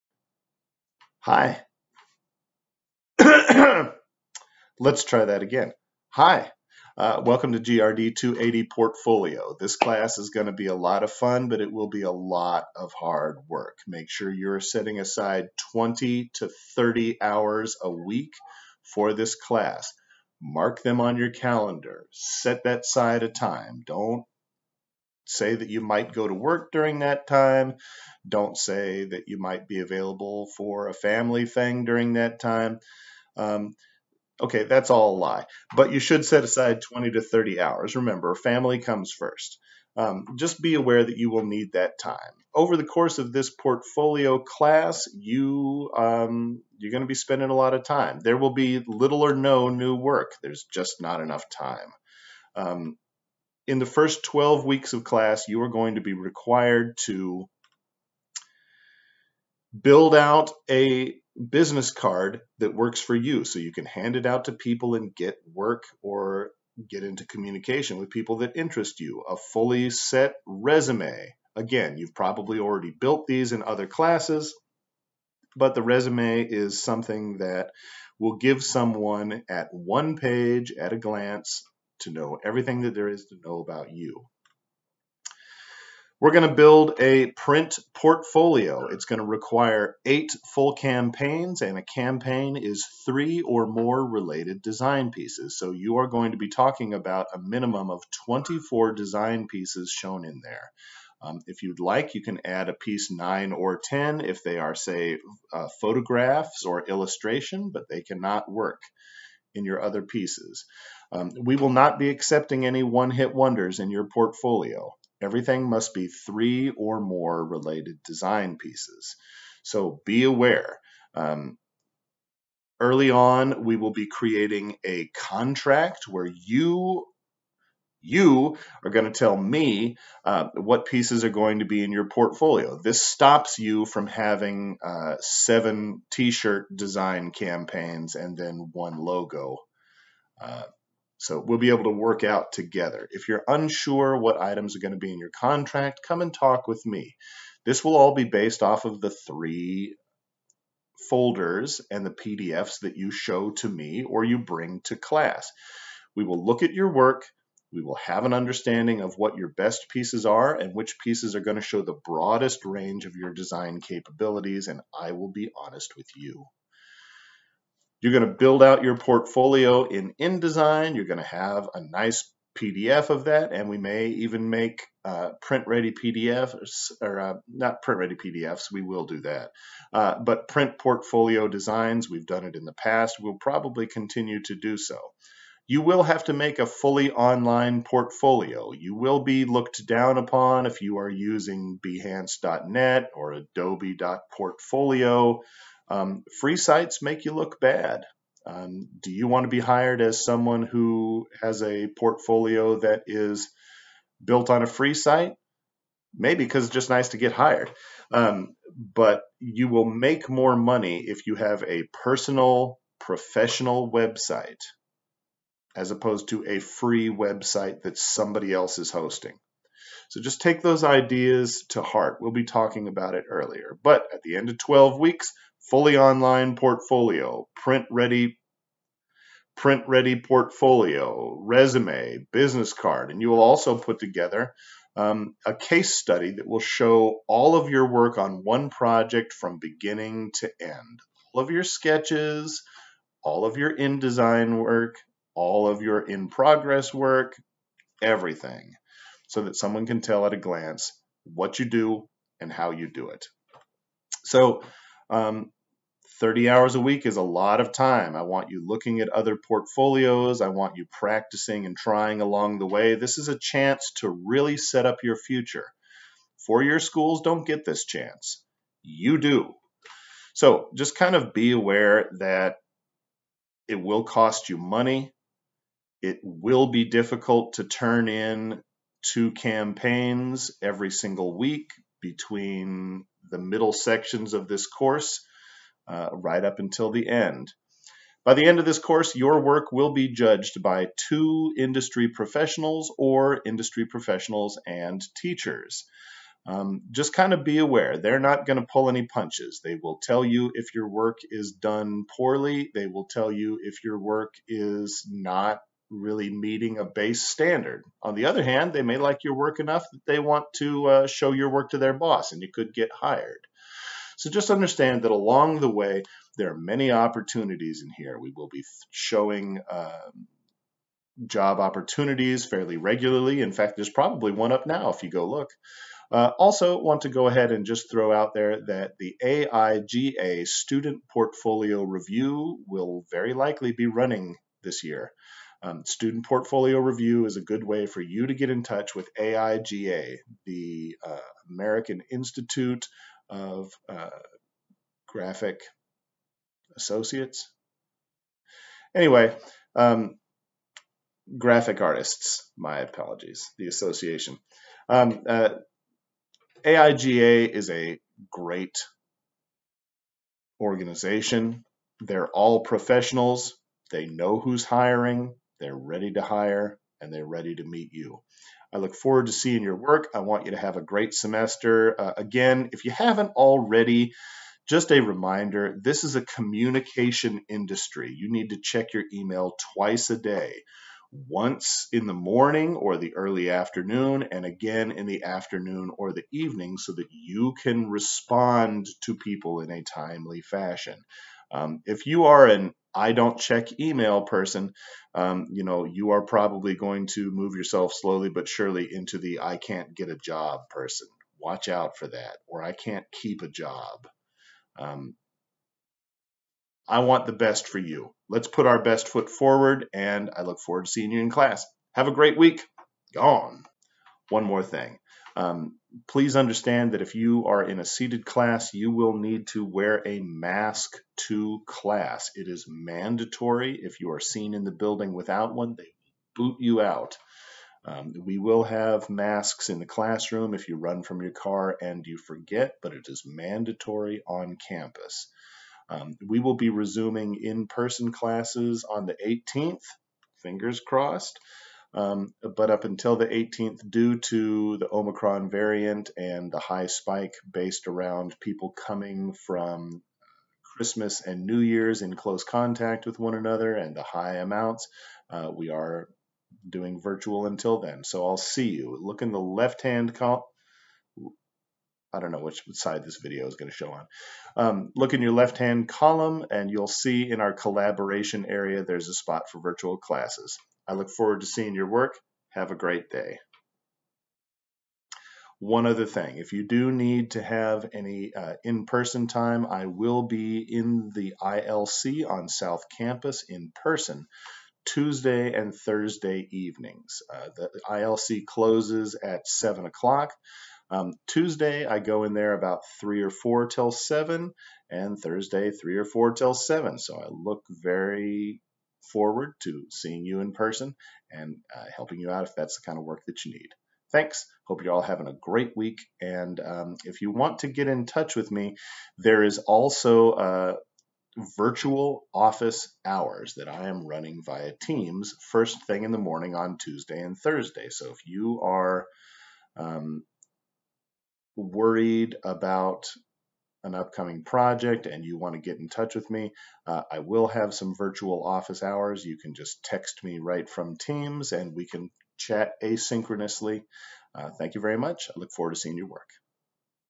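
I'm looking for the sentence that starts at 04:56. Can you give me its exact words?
Um, just kind of be aware, they're not going to pull any punches.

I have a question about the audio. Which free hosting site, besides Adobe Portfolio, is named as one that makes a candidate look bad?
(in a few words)
Behance.net.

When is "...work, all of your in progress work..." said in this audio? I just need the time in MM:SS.
04:04.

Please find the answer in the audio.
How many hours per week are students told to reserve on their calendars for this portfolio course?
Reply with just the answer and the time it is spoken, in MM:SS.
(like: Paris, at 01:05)
20 to 30, at 00:15.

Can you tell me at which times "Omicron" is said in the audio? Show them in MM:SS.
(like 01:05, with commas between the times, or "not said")
07:24.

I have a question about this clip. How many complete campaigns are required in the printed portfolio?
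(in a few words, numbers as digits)
8.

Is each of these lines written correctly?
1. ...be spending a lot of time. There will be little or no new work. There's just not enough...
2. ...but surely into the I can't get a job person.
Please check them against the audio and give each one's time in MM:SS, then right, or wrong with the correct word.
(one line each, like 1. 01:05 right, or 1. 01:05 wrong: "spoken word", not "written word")
1. 00:47 right
2. 06:38 right.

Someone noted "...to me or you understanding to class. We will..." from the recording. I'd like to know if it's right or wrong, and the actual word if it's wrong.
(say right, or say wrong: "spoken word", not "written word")
wrong: "bring", not "understanding".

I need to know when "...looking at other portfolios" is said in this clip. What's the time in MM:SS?
04:18.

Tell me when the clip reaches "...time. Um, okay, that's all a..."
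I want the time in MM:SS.
00:32.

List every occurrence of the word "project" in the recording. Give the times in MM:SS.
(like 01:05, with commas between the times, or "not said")
03:58, 08:44.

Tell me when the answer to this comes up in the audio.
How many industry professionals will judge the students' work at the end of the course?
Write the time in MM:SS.
04:51.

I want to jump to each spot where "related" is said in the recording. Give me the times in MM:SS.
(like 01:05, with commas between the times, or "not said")
01:34, 01:57.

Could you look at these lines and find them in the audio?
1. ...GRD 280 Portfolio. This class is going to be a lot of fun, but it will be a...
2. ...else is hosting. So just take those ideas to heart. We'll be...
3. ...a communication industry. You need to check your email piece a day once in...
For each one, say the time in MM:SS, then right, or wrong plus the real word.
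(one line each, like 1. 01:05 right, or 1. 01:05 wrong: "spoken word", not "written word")
1. 00:07 right
2. 03:38 right
3. 06:16 wrong: "twice", not "piece".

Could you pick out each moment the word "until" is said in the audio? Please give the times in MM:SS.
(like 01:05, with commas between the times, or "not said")
04:46, 07:22, 07:37.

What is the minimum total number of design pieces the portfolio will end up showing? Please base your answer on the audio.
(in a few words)
24.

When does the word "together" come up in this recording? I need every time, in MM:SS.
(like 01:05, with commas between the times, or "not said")
02:22, 03:53.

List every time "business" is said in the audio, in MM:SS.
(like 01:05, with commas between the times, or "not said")
01:01, 03:52.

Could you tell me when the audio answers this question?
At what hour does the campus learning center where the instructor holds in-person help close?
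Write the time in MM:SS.
08:09.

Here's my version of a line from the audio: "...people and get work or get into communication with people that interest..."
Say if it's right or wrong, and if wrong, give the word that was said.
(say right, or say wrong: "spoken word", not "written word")
right.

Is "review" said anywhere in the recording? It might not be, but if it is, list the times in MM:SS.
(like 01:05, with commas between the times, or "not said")
05:31, 05:36.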